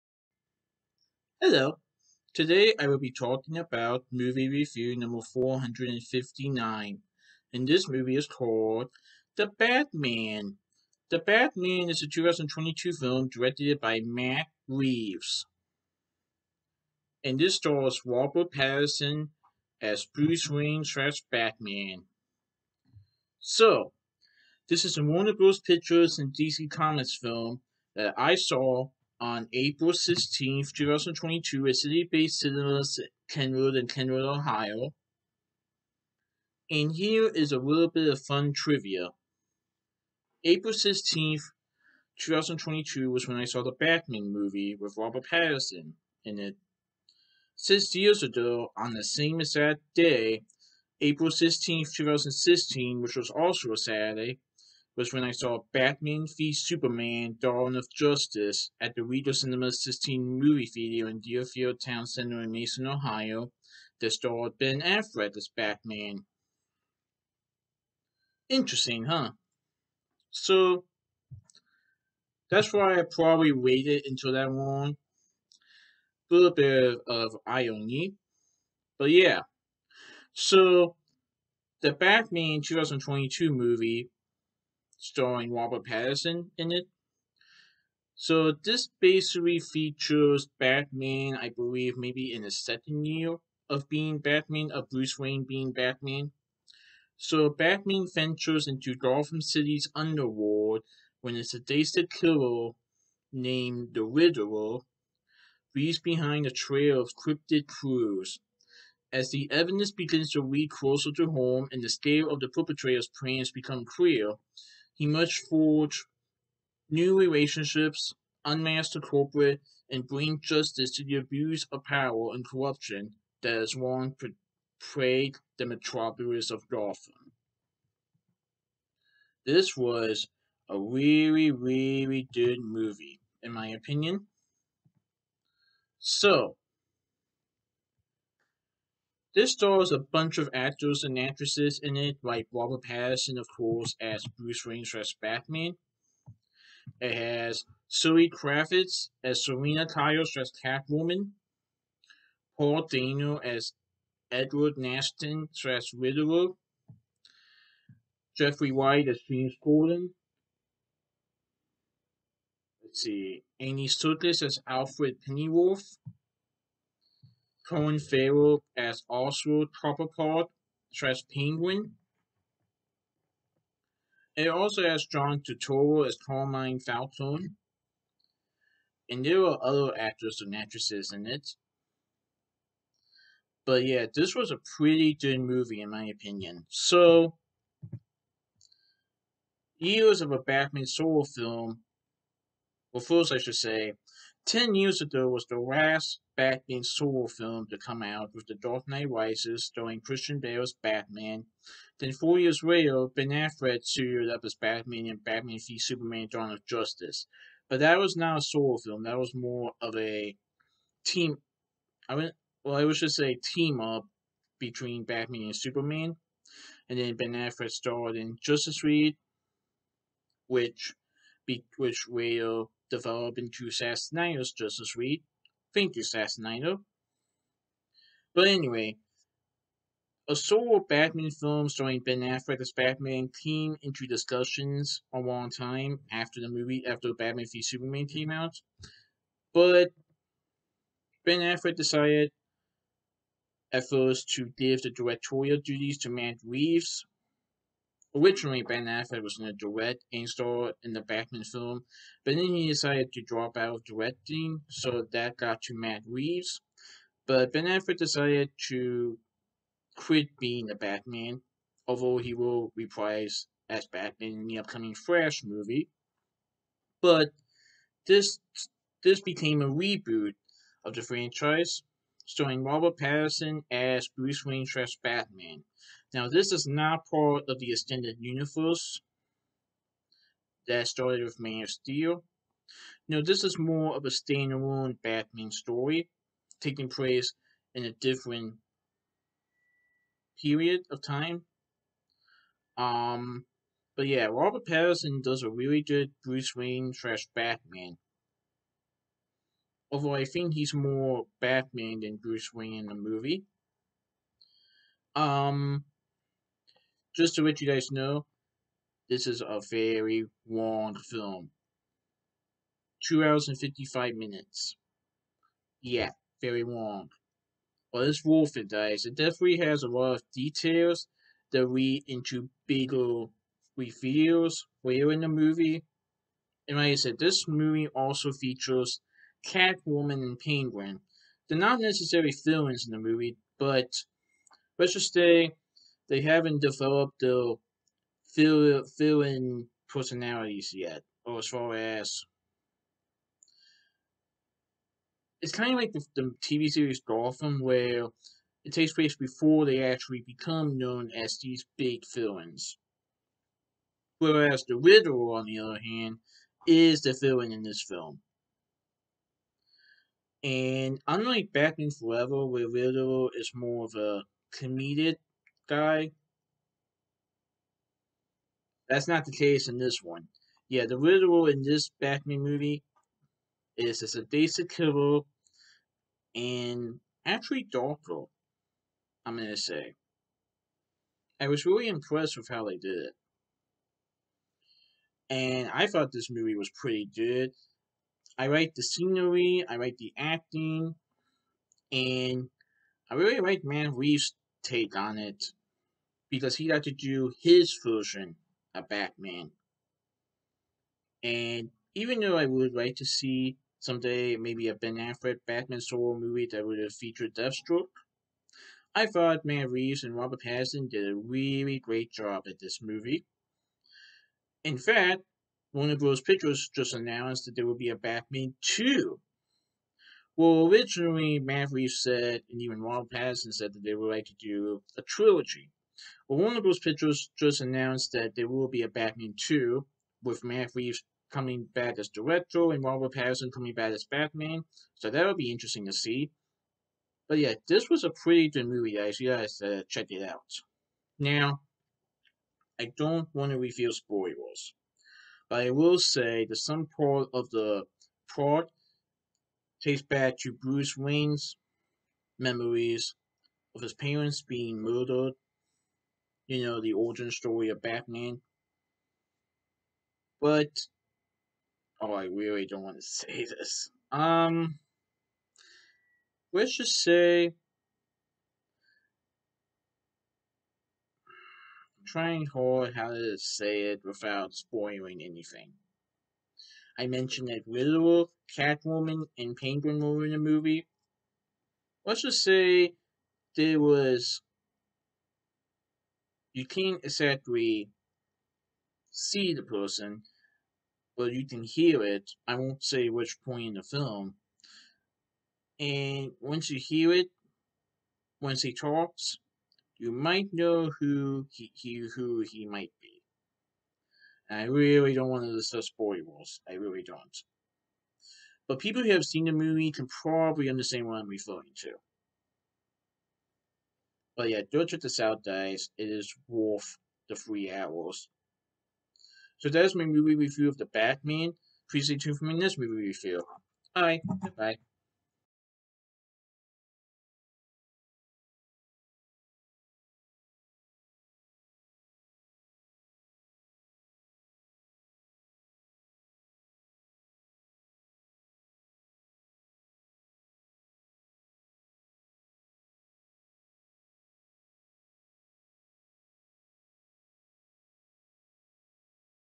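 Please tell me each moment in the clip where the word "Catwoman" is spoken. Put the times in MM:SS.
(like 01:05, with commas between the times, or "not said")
02:30, 05:29, 07:58.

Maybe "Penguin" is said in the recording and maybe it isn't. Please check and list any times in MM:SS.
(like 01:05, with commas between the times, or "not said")
02:51, 05:30, 07:59.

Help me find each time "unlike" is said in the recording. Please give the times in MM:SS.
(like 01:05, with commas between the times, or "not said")
06:01.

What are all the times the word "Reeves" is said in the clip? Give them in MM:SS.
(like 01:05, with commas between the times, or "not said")
00:14, 04:06, 04:16, 06:33, 06:49, 07:01, 07:10.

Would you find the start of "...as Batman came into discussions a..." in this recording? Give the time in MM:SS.
03:52.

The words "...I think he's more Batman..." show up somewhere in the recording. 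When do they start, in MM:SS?
05:00.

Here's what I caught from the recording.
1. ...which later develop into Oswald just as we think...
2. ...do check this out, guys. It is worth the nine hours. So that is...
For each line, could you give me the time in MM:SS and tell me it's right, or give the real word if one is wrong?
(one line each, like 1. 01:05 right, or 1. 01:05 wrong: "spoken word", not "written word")
1. 03:41 wrong: "Assassinitos", not "Oswald"
2. 08:34 wrong: "three", not "nine".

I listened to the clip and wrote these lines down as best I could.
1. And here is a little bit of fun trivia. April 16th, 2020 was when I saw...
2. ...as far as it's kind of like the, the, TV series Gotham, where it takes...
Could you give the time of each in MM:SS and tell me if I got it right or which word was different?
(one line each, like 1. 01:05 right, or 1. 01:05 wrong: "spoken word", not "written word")
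1. 00:36 wrong: "2022", not "2020"
2. 05:41 right.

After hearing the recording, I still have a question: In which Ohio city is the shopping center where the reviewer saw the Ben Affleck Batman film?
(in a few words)
Mason.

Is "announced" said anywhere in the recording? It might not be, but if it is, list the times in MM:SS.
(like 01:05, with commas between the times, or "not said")
06:56, 07:07.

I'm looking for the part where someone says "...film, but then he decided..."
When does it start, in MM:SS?
04:11.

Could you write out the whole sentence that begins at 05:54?
Whereas the Riddler, on the other hand, is the villain in this film.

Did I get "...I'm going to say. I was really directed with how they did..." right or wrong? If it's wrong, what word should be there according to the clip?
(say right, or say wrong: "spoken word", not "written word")
wrong: "impressed", not "directed".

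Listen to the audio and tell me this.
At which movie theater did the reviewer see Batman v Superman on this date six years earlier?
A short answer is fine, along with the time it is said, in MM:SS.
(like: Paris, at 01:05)
Regal Cinema 16, at 00:59.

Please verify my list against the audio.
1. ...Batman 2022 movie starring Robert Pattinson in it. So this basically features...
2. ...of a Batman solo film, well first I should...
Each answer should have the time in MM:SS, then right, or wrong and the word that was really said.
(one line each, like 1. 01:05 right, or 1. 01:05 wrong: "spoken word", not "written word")
1. 01:21 right
2. 03:10 right.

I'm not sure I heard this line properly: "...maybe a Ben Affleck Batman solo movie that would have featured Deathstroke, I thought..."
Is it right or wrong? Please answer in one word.
right.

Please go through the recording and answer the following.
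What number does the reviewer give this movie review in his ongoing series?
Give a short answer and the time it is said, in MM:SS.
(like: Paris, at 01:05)
459, at 00:05.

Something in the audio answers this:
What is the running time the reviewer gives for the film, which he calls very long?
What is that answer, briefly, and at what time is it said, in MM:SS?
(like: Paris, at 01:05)
2 hours 55 minutes, at 05:13.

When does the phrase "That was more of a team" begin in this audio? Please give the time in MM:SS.
03:29.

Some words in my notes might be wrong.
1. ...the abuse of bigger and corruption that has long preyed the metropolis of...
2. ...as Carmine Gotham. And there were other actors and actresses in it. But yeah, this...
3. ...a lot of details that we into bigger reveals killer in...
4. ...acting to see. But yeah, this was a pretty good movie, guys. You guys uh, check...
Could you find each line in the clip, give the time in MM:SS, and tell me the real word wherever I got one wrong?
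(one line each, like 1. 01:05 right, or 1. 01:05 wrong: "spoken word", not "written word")
1. 02:01 wrong: "power", not "bigger"
2. 02:56 wrong: "Falcone", not "Gotham"
3. 05:19 wrong: "later", not "killer"
4. 07:15 wrong: "interesting", not "acting".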